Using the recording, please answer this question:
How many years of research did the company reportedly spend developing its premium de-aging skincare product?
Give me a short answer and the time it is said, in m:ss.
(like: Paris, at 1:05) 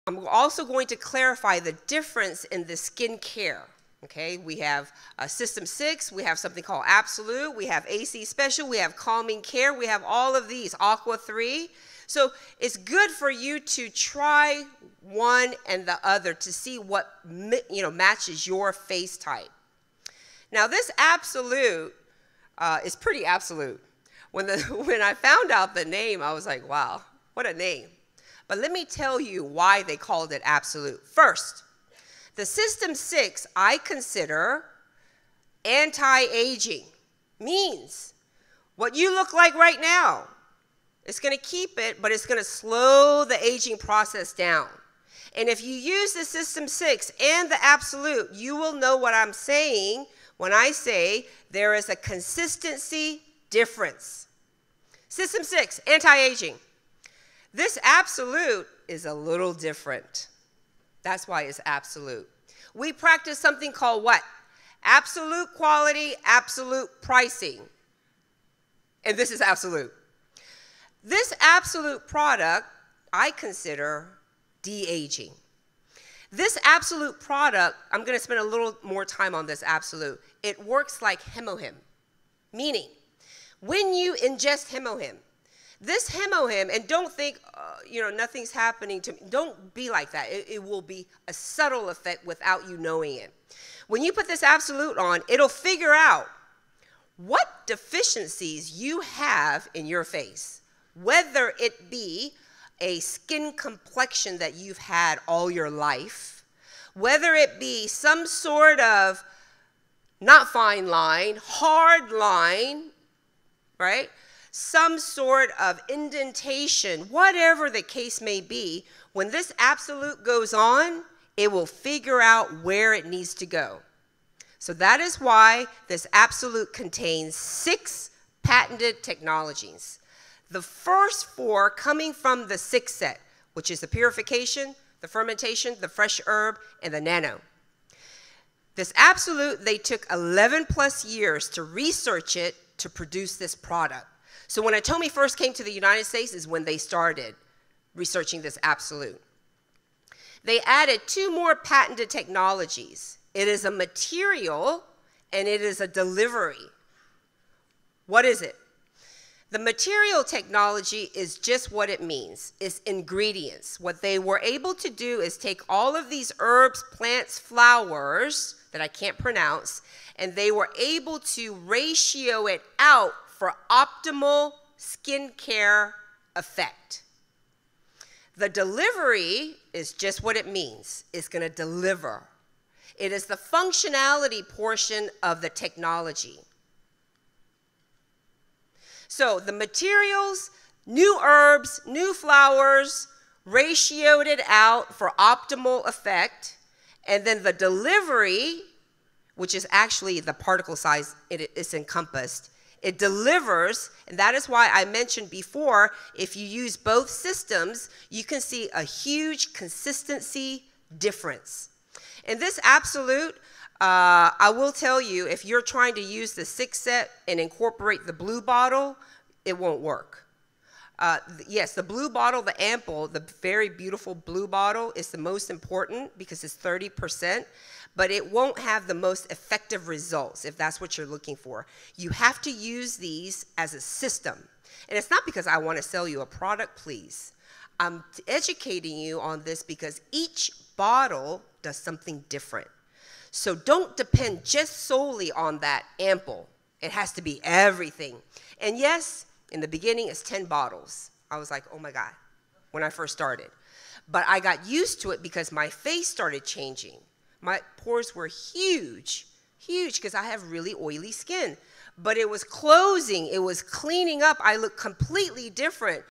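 11 plus years, at 2:20.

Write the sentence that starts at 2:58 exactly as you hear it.
The delivery is just what it means.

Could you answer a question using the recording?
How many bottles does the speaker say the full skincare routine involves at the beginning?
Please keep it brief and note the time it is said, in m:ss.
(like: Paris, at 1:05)
10, at 4:10.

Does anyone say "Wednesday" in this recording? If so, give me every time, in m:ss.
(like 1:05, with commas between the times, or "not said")
not said.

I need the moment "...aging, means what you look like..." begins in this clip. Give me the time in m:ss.
0:36.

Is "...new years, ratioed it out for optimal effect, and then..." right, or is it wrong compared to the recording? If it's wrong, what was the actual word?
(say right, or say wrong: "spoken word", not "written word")
wrong: "flowers", not "years".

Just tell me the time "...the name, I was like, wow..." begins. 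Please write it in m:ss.
0:25.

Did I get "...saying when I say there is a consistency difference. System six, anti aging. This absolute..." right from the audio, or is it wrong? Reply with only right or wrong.
right.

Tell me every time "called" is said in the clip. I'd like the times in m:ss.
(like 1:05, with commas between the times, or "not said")
0:06, 0:29, 1:03.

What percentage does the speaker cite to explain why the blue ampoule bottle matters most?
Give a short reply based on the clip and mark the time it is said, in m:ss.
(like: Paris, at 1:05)
30%, at 3:46.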